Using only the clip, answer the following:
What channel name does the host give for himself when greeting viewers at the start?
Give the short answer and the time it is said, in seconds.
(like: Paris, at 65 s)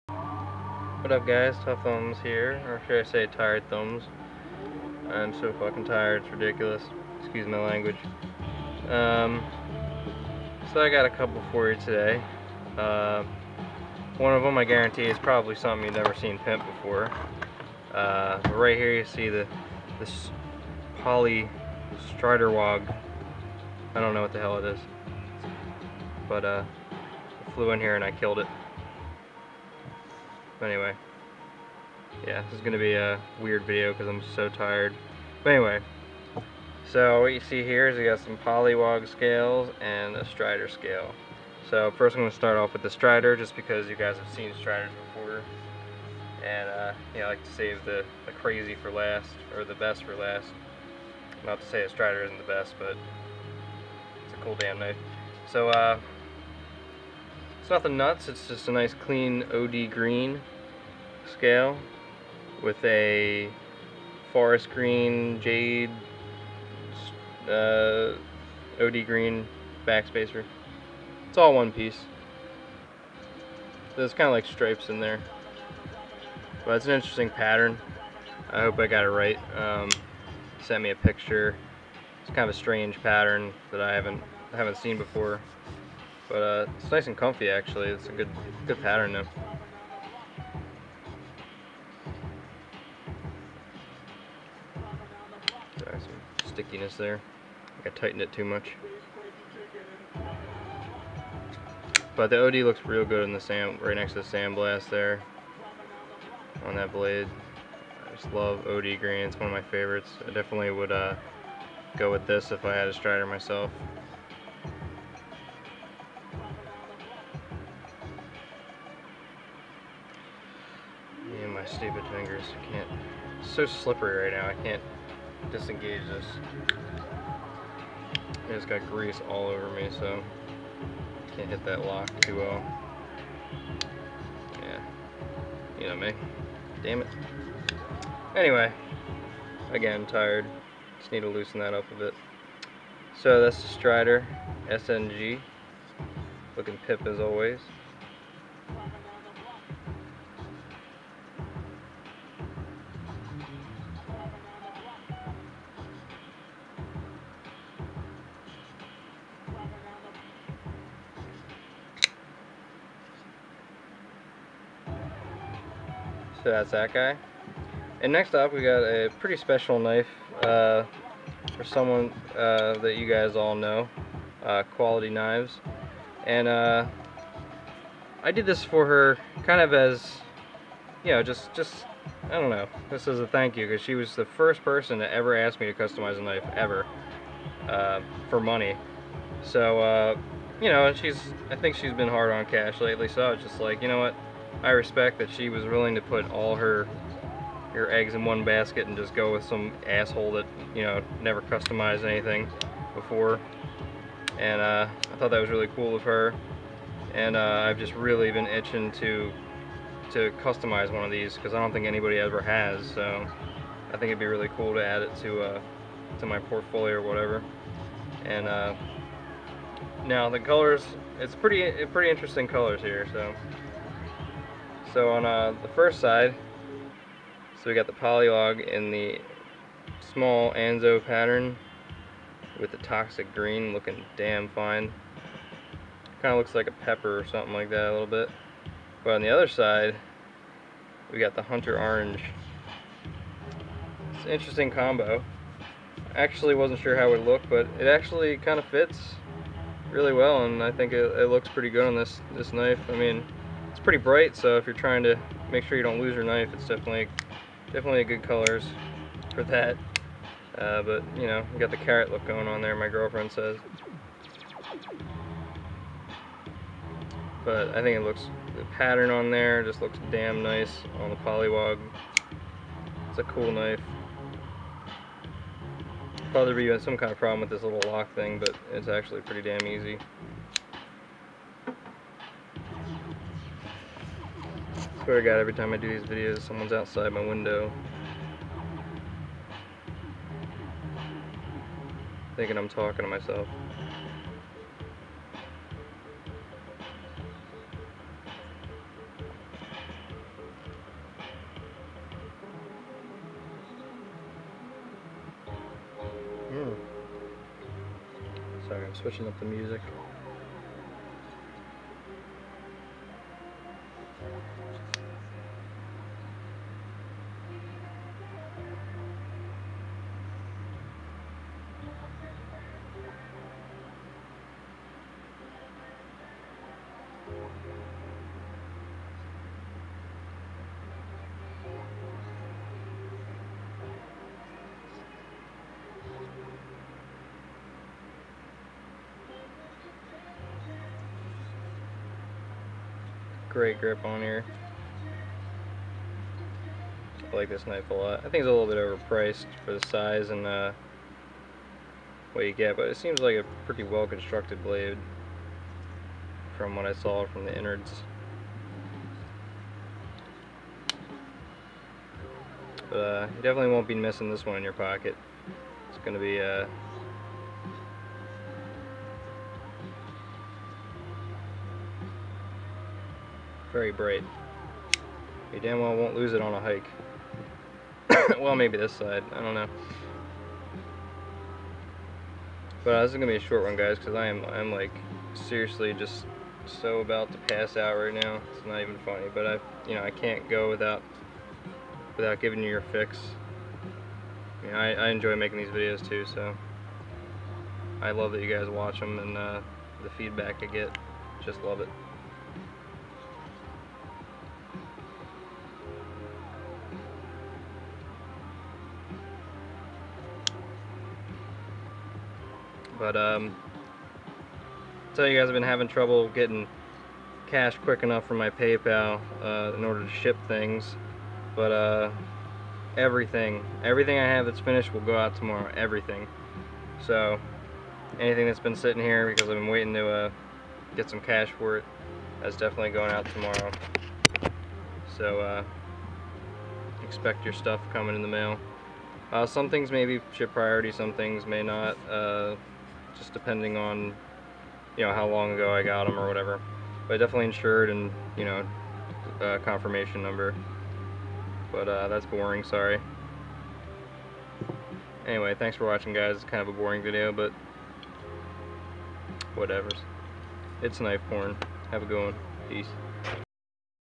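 Tuffthumbz, at 1 s.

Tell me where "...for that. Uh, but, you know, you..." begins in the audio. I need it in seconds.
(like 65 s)
259 s.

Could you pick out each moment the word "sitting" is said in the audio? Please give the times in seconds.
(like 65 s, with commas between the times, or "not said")
428 s.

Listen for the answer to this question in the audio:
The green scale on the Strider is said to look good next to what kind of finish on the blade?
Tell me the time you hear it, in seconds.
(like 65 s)
104 s.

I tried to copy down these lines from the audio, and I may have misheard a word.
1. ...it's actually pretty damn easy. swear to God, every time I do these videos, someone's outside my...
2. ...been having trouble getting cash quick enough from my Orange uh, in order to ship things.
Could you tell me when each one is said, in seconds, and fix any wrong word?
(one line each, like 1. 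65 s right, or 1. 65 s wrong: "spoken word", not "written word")
1. 278 s right
2. 415 s wrong: "PayPal", not "Orange".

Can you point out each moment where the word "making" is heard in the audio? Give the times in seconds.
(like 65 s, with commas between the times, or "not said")
395 s.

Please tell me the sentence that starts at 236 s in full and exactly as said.
Kind of looks like a pepper or something like that a little bit.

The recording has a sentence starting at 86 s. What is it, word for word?
But uh, it's nice and comfy actually.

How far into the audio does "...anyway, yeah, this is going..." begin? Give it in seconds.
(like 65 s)
30 s.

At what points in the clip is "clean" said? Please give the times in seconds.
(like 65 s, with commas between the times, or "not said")
58 s.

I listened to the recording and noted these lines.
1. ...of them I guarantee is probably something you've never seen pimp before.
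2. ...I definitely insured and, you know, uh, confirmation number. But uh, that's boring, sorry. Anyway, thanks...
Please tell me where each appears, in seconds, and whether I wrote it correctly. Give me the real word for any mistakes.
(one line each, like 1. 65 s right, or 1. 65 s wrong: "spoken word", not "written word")
1. 14 s right
2. 447 s right.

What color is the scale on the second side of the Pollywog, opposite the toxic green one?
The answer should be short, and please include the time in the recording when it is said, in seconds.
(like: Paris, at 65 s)
Hunter Orange, at 241 s.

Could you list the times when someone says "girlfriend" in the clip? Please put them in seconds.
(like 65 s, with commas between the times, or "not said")
262 s.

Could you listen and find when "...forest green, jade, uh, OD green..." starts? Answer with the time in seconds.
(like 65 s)
64 s.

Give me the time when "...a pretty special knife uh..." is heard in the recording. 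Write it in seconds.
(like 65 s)
168 s.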